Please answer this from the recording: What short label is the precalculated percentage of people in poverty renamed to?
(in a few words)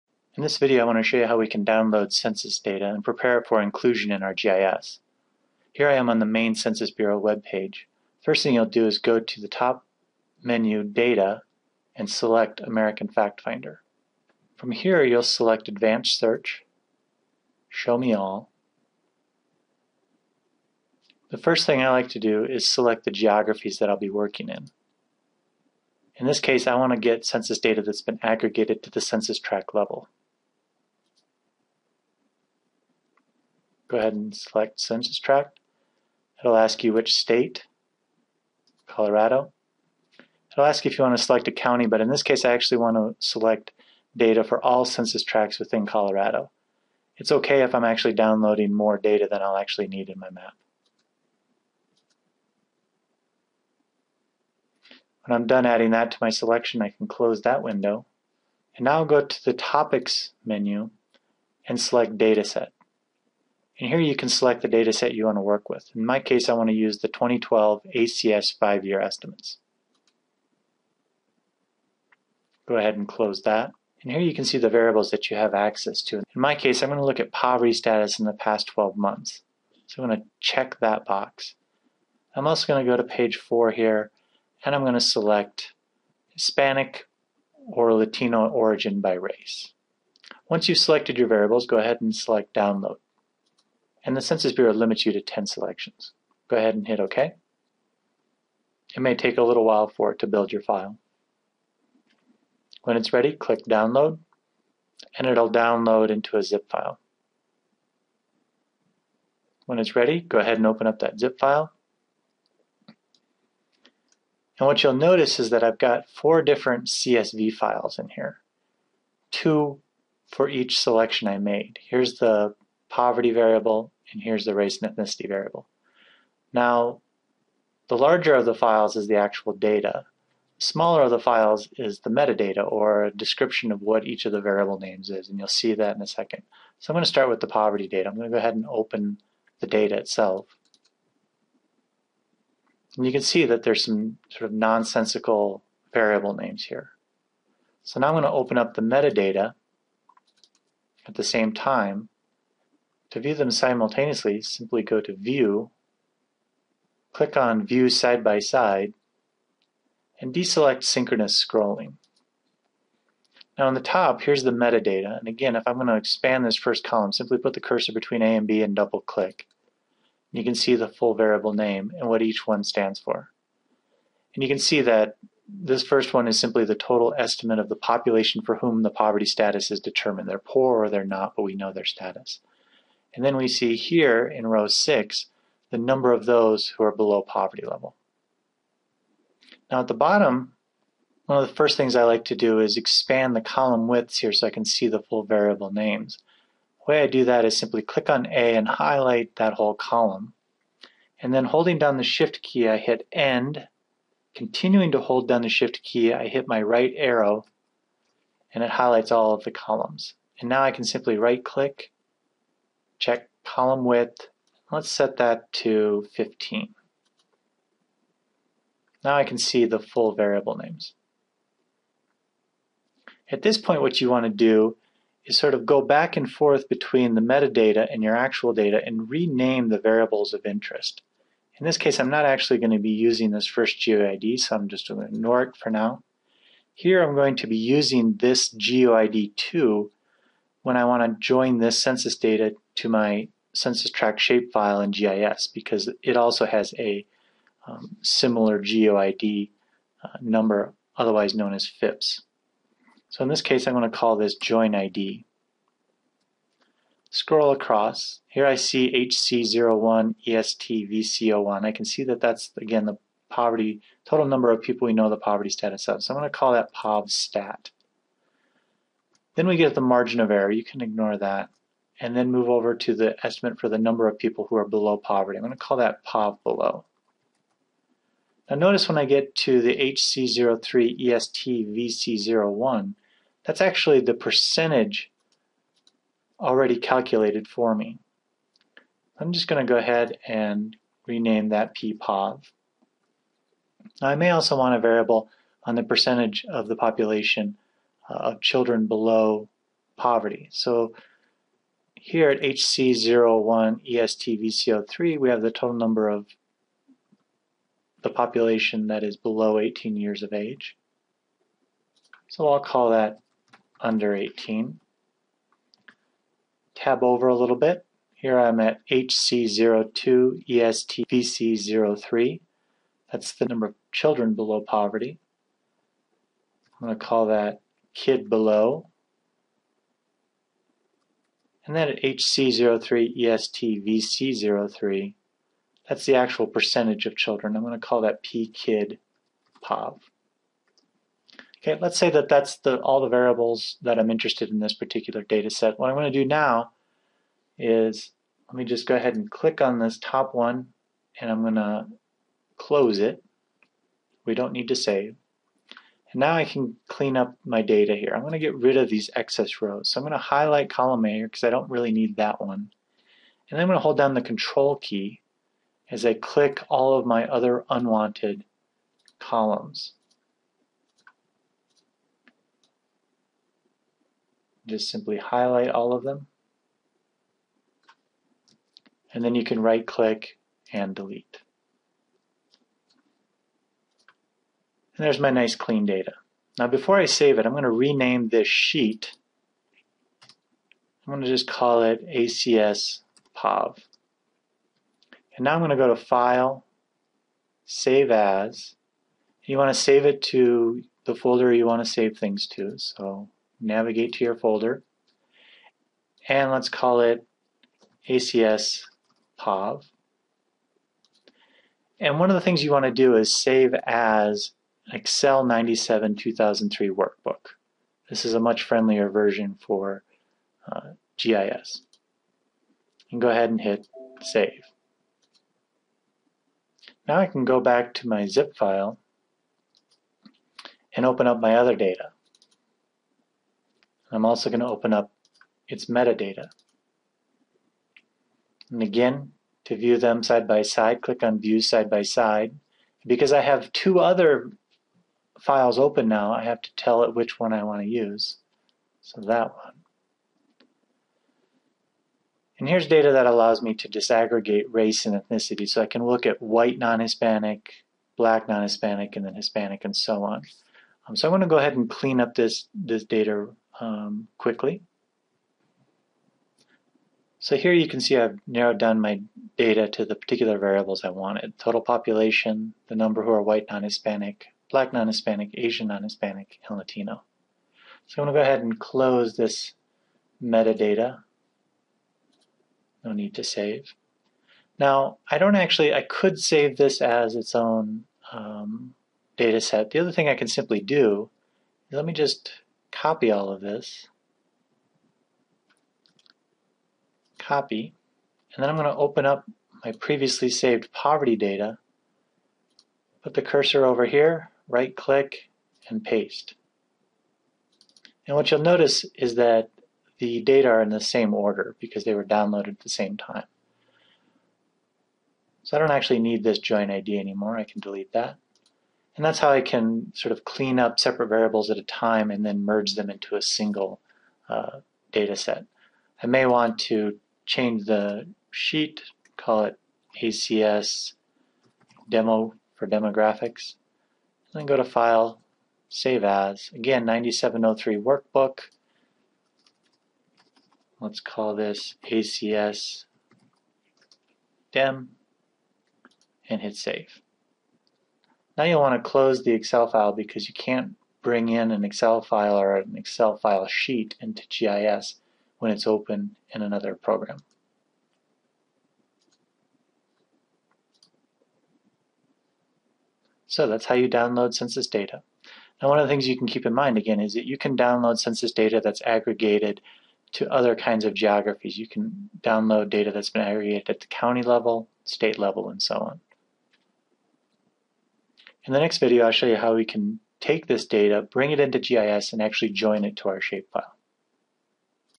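PPOV.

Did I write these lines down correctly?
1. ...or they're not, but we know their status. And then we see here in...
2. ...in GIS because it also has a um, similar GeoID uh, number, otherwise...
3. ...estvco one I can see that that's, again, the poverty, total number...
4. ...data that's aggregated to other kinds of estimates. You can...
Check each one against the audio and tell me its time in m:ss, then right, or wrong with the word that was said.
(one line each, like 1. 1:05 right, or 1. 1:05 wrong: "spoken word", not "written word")
1. 3:00 right
2. 4:04 right
3. 4:20 right
4. 9:28 wrong: "geographies", not "estimates".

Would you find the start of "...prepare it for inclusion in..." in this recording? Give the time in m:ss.
0:03.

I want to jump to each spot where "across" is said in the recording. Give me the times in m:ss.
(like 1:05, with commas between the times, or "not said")
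4:17.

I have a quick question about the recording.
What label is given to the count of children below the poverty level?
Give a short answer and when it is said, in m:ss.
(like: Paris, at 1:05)
kid below, at 5:27.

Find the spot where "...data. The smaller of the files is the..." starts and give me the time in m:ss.
2:09.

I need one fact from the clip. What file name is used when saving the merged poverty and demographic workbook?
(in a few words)
ACS DEM.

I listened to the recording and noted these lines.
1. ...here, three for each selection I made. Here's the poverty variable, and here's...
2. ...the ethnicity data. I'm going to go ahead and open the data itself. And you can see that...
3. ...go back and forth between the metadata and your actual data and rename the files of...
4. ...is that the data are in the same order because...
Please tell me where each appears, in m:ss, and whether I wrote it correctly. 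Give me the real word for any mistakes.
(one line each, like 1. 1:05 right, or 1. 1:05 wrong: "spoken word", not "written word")
1. 1:58 wrong: "two", not "three"
2. 2:17 wrong: "poverty", not "ethnicity"
3. 3:45 wrong: "variables", not "files"
4. 8:29 right.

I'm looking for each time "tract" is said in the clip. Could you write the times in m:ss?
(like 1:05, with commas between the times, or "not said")
0:29, 0:35, 0:45, 4:03.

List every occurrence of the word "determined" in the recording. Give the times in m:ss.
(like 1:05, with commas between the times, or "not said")
2:59.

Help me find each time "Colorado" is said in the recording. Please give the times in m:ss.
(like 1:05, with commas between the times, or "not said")
0:38, 0:45.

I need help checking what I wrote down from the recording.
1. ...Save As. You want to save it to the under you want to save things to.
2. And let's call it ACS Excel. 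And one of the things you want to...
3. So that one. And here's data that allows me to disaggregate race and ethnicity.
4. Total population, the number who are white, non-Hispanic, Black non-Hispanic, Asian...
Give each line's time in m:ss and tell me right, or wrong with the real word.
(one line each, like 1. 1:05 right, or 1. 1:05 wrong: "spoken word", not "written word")
1. 6:37 wrong: "folder", not "under"
2. 6:46 wrong: "POV", not "Excel"
3. 7:29 right
4. 7:51 right.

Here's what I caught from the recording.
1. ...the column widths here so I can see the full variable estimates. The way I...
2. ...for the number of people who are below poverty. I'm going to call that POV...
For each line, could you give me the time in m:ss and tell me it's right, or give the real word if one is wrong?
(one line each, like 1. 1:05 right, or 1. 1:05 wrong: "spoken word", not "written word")
1. 3:13 wrong: "names", not "estimates"
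2. 4:33 right.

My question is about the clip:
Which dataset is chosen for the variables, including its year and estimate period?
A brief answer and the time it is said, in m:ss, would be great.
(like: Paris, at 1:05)
2012 ACS five-year estimates, at 1:07.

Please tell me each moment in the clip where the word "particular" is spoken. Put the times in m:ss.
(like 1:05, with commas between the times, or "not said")
5:44, 7:50.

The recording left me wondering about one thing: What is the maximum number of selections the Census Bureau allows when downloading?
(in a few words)
10.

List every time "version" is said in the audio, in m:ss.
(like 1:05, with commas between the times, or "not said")
6:59.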